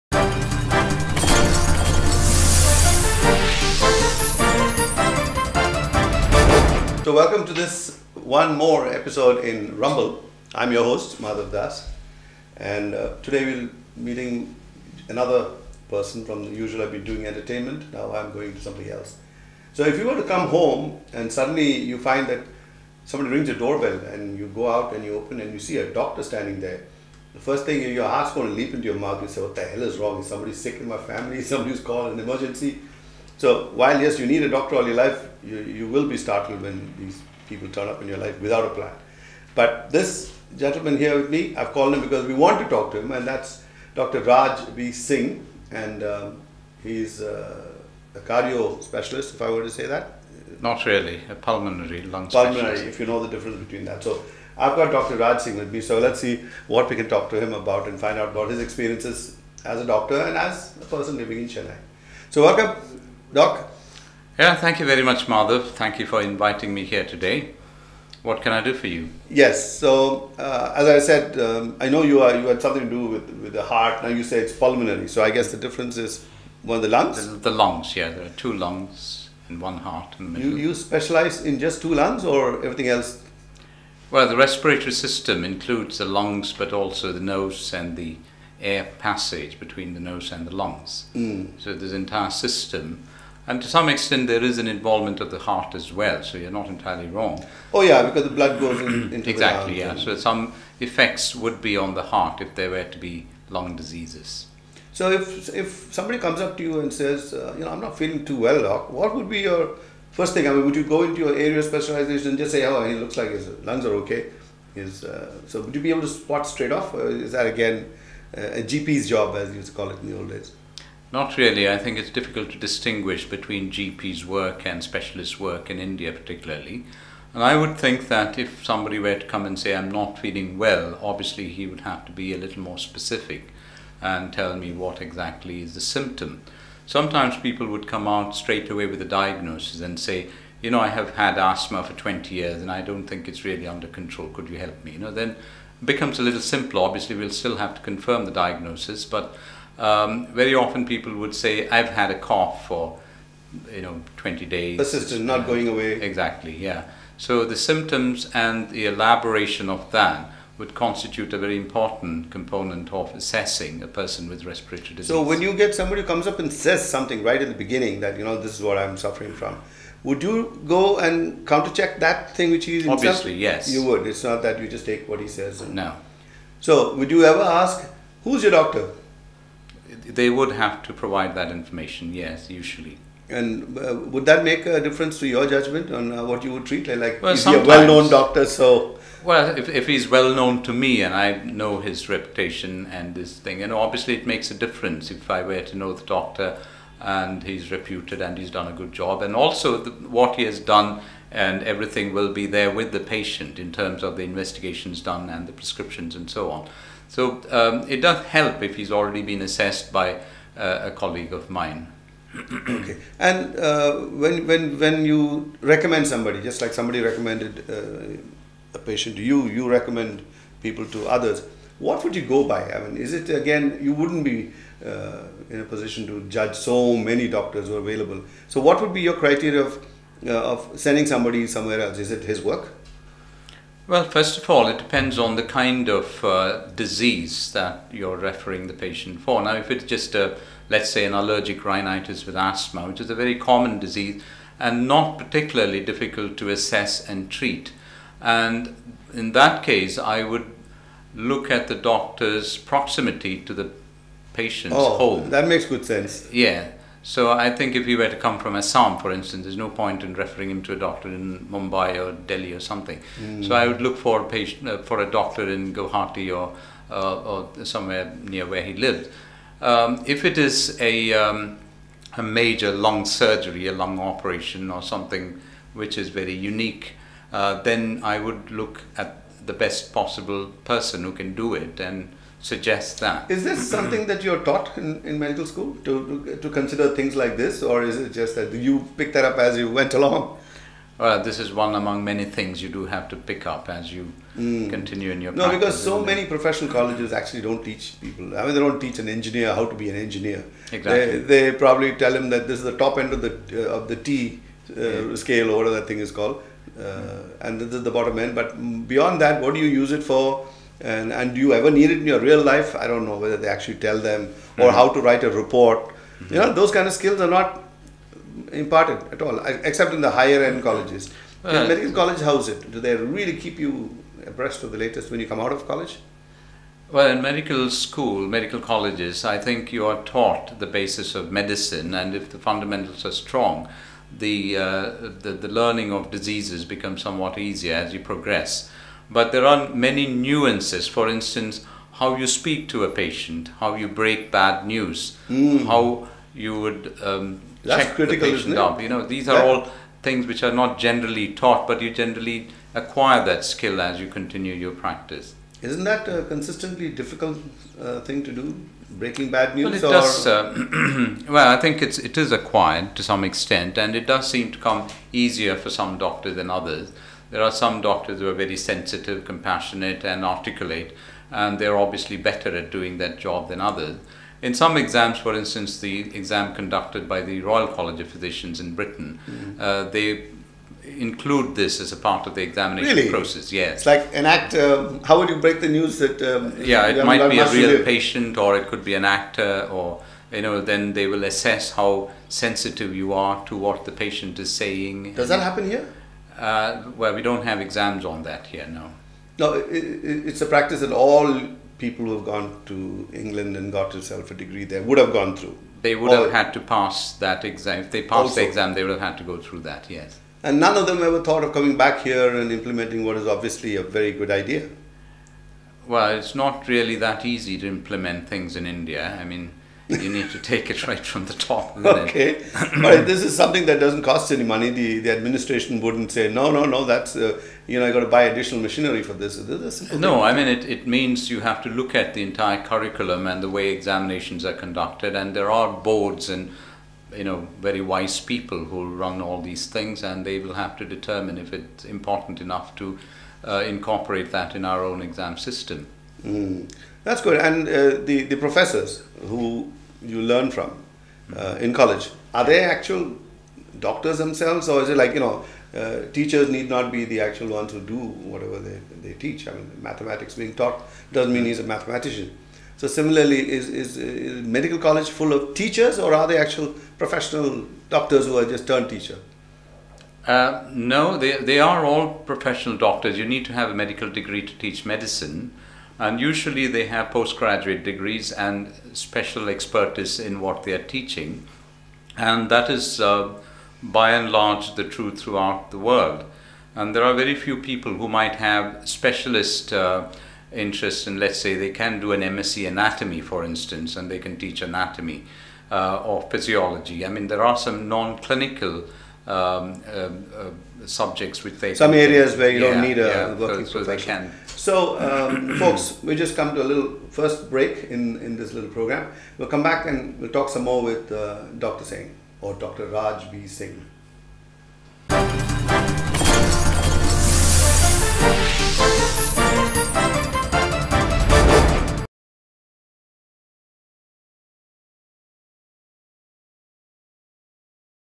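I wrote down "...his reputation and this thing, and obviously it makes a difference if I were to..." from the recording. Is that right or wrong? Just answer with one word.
right.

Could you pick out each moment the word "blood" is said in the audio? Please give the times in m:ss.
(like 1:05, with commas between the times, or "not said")
1:38.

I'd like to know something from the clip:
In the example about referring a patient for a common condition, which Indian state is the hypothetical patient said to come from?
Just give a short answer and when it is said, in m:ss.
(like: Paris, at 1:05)
Assam, at 4:18.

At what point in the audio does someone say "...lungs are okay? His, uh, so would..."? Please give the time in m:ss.
1:53.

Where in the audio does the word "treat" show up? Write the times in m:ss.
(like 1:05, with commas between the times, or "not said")
3:06, 4:07.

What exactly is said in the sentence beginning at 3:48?
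So, what would be your criteria of, uh, of sending somebody somewhere else?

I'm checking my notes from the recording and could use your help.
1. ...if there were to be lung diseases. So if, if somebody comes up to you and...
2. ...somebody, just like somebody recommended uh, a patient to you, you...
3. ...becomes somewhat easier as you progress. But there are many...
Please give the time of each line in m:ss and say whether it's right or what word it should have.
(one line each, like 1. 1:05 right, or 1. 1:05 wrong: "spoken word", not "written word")
1. 1:42 right
2. 3:36 right
3. 5:36 right.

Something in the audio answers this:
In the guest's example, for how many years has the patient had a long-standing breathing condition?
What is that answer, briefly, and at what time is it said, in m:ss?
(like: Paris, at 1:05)
20, at 2:21.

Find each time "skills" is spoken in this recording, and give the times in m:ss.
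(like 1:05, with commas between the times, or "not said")
5:16, 5:53.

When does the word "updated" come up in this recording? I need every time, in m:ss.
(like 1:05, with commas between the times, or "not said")
not said.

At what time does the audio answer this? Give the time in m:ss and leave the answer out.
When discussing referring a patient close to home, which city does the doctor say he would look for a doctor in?
4:25.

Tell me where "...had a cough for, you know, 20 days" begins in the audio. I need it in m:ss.
2:31.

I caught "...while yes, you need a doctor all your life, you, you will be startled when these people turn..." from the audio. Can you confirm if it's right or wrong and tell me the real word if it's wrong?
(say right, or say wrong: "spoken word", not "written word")
right.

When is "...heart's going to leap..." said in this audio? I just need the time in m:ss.
0:28.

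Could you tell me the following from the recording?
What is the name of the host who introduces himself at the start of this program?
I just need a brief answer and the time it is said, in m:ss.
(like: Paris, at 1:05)
Madhav Das, at 0:11.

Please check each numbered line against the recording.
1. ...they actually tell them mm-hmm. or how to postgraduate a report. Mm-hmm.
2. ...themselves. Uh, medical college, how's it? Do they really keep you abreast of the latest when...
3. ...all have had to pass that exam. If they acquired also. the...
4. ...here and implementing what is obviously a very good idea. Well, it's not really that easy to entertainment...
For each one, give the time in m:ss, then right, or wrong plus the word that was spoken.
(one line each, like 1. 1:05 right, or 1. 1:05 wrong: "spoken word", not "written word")
1. 5:13 wrong: "write", not "postgraduate"
2. 5:20 wrong: "colleges", not "themselves"
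3. 6:46 wrong: "passed", not "acquired"
4. 6:52 wrong: "implement", not "entertainment".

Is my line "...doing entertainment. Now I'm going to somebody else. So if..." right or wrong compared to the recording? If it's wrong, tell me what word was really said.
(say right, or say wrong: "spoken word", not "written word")
right.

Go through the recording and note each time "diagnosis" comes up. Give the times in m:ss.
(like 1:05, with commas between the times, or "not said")
2:19, 2:28.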